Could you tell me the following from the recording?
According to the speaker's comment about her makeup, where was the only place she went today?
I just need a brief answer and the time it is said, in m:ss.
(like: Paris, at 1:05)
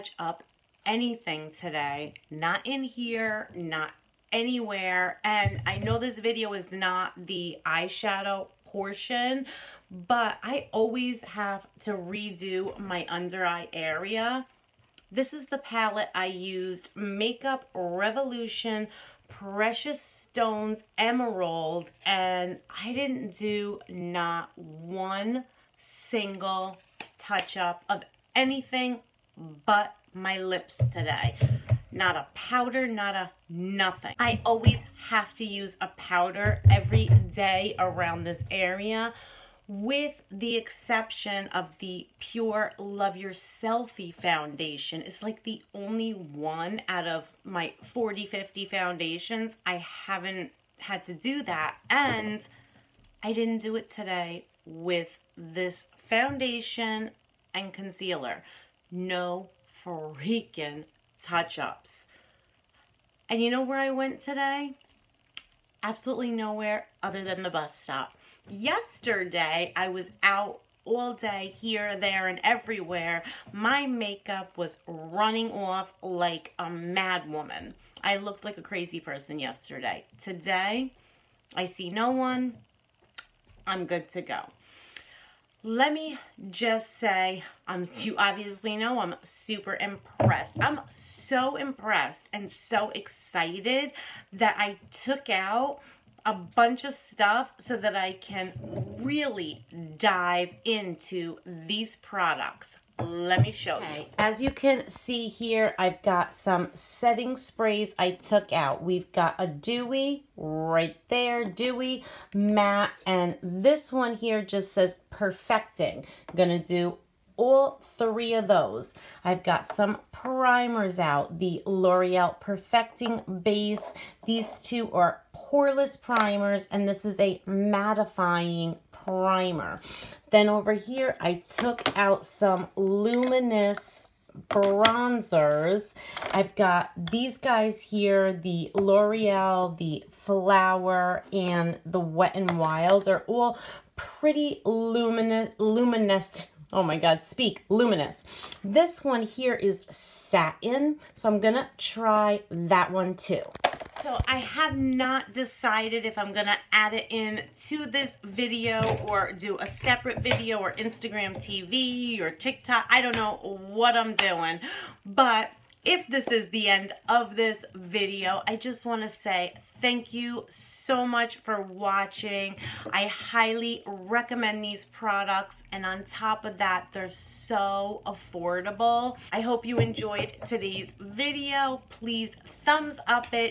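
The bus stop, at 1:07.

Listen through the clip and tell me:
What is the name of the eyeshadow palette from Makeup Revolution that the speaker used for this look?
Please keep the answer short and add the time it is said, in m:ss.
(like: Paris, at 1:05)
Precious Stones Emerald, at 0:19.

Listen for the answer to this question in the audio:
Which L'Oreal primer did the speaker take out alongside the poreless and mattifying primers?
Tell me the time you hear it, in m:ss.
2:01.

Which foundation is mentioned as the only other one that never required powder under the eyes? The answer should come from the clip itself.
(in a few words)
PÜR Love Your Selfie.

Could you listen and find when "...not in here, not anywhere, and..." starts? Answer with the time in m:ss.
0:02.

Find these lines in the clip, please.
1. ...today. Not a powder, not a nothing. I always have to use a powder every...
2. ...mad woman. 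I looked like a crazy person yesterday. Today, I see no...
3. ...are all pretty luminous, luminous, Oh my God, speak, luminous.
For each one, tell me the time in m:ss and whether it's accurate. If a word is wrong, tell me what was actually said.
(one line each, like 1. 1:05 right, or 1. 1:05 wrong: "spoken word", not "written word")
1. 0:30 right
2. 1:16 right
3. 2:23 right.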